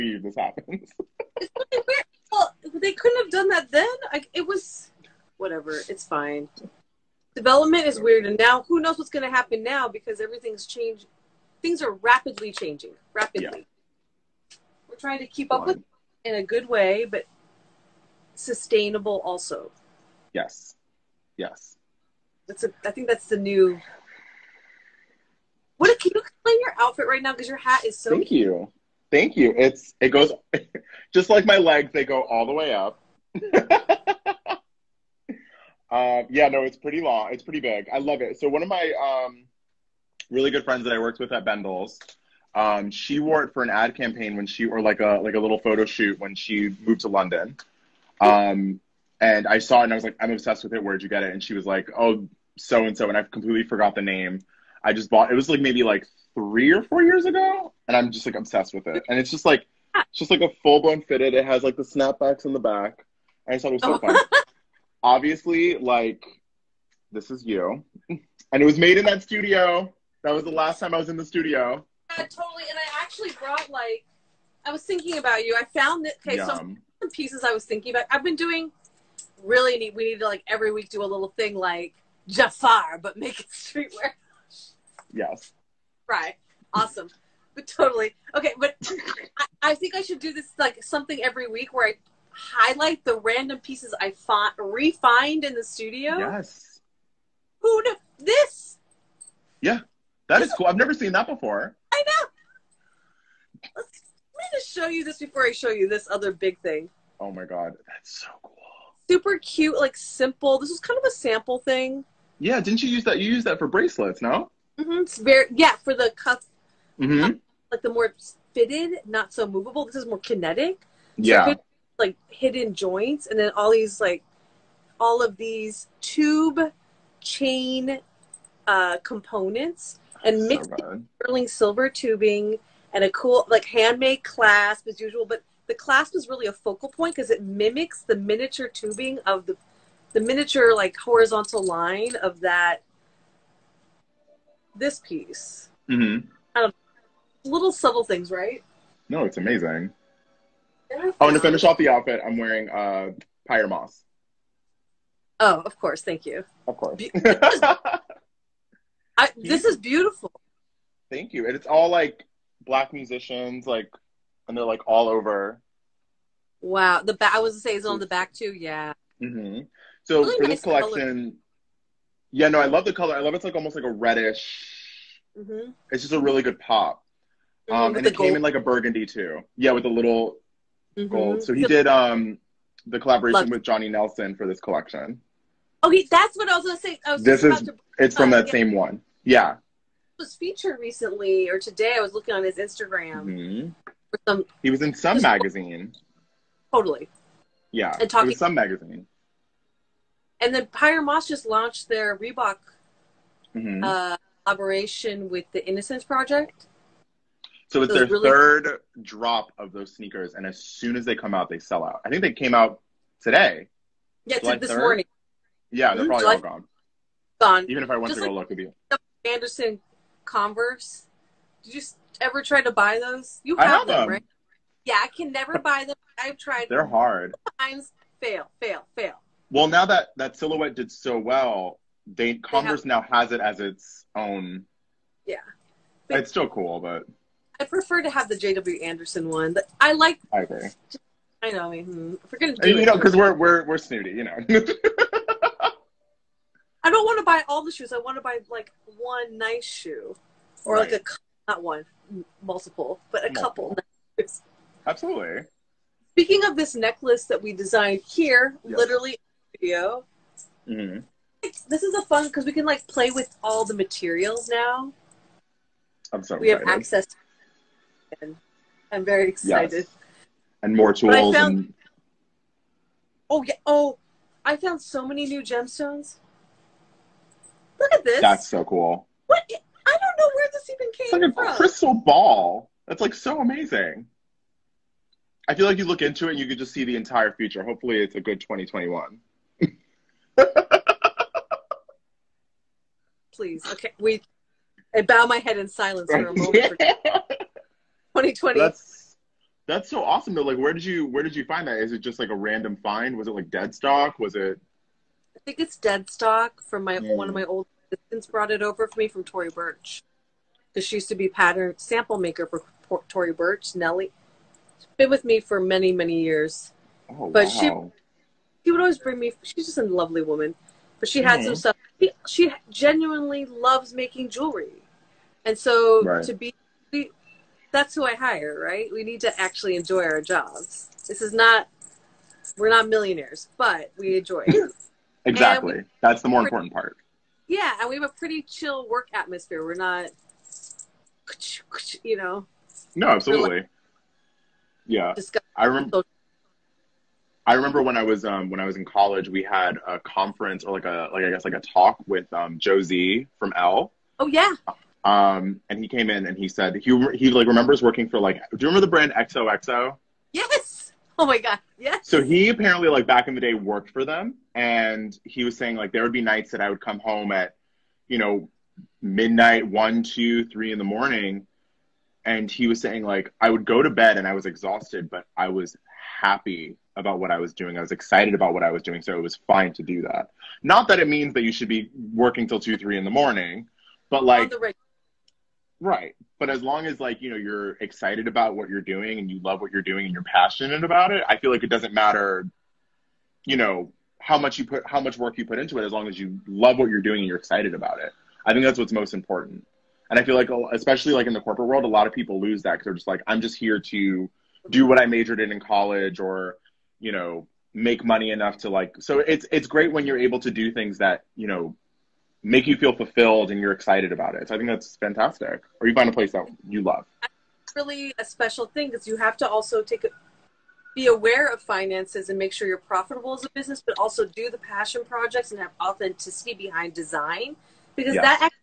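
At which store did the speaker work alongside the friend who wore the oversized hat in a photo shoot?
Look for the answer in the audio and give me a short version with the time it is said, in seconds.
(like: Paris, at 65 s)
Bendel's, at 41 s.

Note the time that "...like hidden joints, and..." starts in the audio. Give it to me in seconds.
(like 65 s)
121 s.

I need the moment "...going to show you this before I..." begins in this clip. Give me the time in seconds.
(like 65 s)
104 s.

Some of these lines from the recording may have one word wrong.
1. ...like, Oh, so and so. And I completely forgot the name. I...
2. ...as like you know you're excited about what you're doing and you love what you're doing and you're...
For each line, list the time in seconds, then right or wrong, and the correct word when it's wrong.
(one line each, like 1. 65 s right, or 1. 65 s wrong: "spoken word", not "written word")
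1. 51 s right
2. 386 s right.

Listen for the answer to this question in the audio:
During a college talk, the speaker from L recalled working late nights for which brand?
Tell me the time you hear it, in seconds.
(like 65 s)
359 s.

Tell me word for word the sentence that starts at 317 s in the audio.
Oh, but wow he would always bring me.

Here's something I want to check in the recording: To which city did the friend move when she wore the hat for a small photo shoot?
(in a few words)
London.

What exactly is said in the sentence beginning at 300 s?
Like where did you where did you find that?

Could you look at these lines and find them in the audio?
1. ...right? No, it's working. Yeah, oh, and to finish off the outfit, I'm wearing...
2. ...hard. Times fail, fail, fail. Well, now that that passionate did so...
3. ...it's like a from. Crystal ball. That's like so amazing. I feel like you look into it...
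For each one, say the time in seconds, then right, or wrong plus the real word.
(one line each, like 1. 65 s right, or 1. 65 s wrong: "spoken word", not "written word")
1. 148 s wrong: "amazing", not "working"
2. 226 s wrong: "silhouette", not "passionate"
3. 281 s right.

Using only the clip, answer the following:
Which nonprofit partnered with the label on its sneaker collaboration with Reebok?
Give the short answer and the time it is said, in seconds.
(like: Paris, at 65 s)
Innocence Project, at 205 s.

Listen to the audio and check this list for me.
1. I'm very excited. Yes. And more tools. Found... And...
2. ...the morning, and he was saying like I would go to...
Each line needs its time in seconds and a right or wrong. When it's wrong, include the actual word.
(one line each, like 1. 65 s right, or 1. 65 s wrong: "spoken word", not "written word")
1. 268 s right
2. 370 s right.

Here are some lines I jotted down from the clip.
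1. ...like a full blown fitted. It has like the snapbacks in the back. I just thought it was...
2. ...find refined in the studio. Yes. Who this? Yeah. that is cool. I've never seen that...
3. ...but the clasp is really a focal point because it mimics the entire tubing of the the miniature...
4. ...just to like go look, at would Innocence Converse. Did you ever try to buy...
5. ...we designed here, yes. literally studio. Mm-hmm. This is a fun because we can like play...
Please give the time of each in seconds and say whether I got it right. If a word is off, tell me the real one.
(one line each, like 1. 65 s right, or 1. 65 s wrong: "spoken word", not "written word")
1. 60 s right
2. 94 s right
3. 135 s wrong: "miniature", not "entire"
4. 218 s wrong: "Anderson", not "Innocence"
5. 257 s right.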